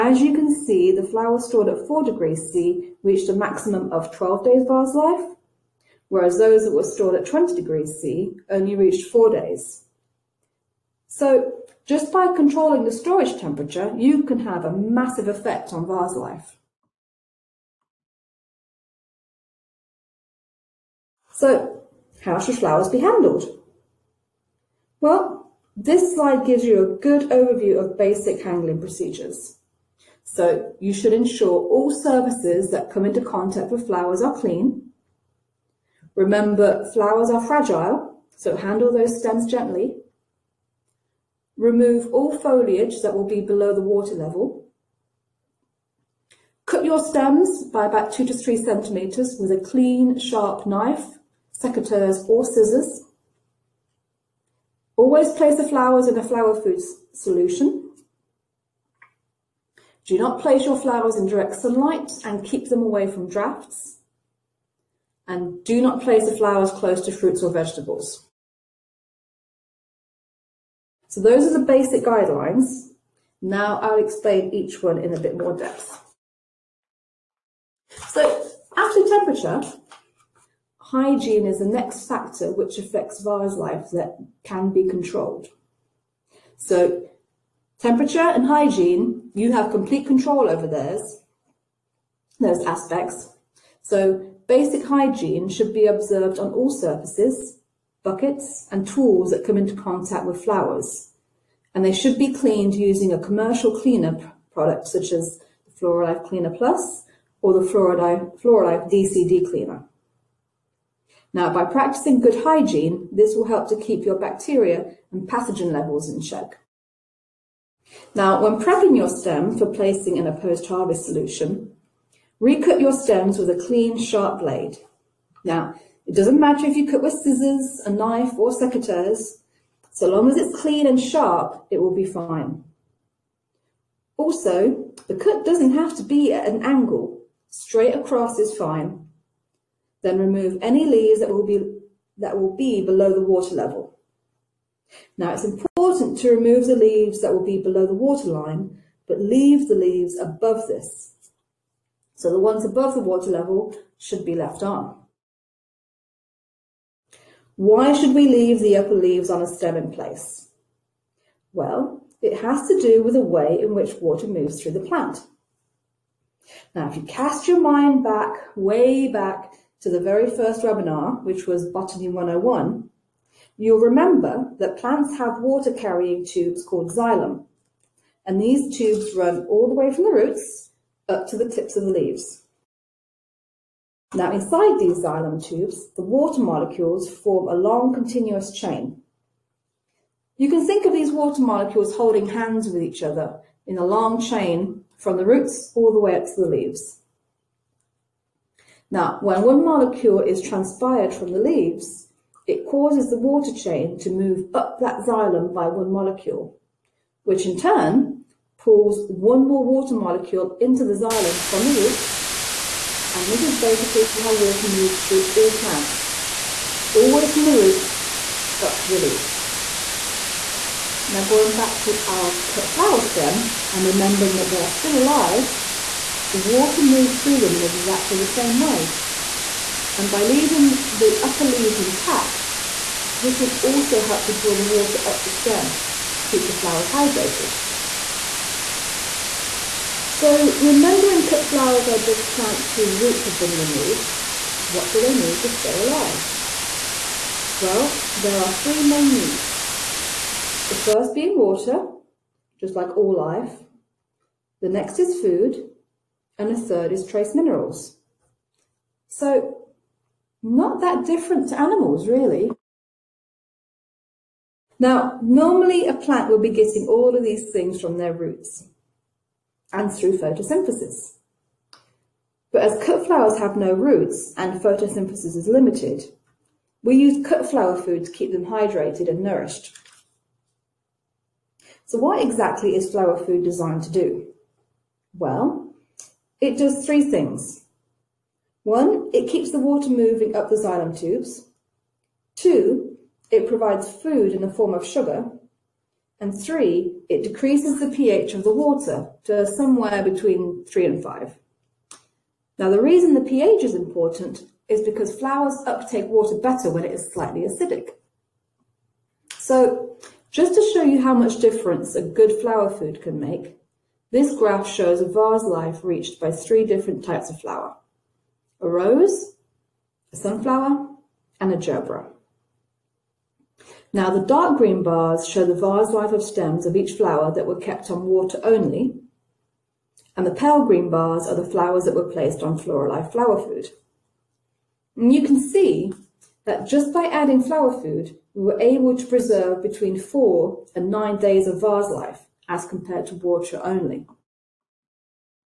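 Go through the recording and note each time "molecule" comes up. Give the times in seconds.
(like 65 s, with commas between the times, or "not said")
186 s, 191 s, 199 s, 205 s, 209 s.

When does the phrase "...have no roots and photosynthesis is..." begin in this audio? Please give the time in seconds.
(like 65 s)
273 s.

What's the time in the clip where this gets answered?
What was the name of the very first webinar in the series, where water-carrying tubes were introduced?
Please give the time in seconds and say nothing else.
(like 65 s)
171 s.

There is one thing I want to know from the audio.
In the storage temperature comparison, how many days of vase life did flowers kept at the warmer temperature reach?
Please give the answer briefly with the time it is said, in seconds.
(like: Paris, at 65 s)
4 days, at 9 s.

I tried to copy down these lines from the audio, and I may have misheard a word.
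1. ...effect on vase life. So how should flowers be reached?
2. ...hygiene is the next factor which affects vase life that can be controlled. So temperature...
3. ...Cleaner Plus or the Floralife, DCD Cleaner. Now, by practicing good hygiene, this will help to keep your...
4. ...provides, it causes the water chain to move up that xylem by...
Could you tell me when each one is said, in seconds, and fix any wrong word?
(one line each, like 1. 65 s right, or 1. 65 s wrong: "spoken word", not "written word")
1. 15 s wrong: "handled", not "reached"
2. 80 s right
3. 106 s right
4. 201 s wrong: "leaves", not "provides".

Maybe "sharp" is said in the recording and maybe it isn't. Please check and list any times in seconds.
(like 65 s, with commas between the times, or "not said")
50 s, 123 s, 131 s.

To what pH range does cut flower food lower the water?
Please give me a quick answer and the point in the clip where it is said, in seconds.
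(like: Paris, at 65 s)
3 to 5, at 300 s.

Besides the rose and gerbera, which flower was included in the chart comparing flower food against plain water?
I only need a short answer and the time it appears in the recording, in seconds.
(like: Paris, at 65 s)
Sunflower, at 320 s.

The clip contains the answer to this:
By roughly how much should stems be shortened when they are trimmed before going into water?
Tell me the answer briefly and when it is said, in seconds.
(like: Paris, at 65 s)
2 to 3 centimetres, at 48 s.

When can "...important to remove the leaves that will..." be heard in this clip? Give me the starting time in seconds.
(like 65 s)
145 s.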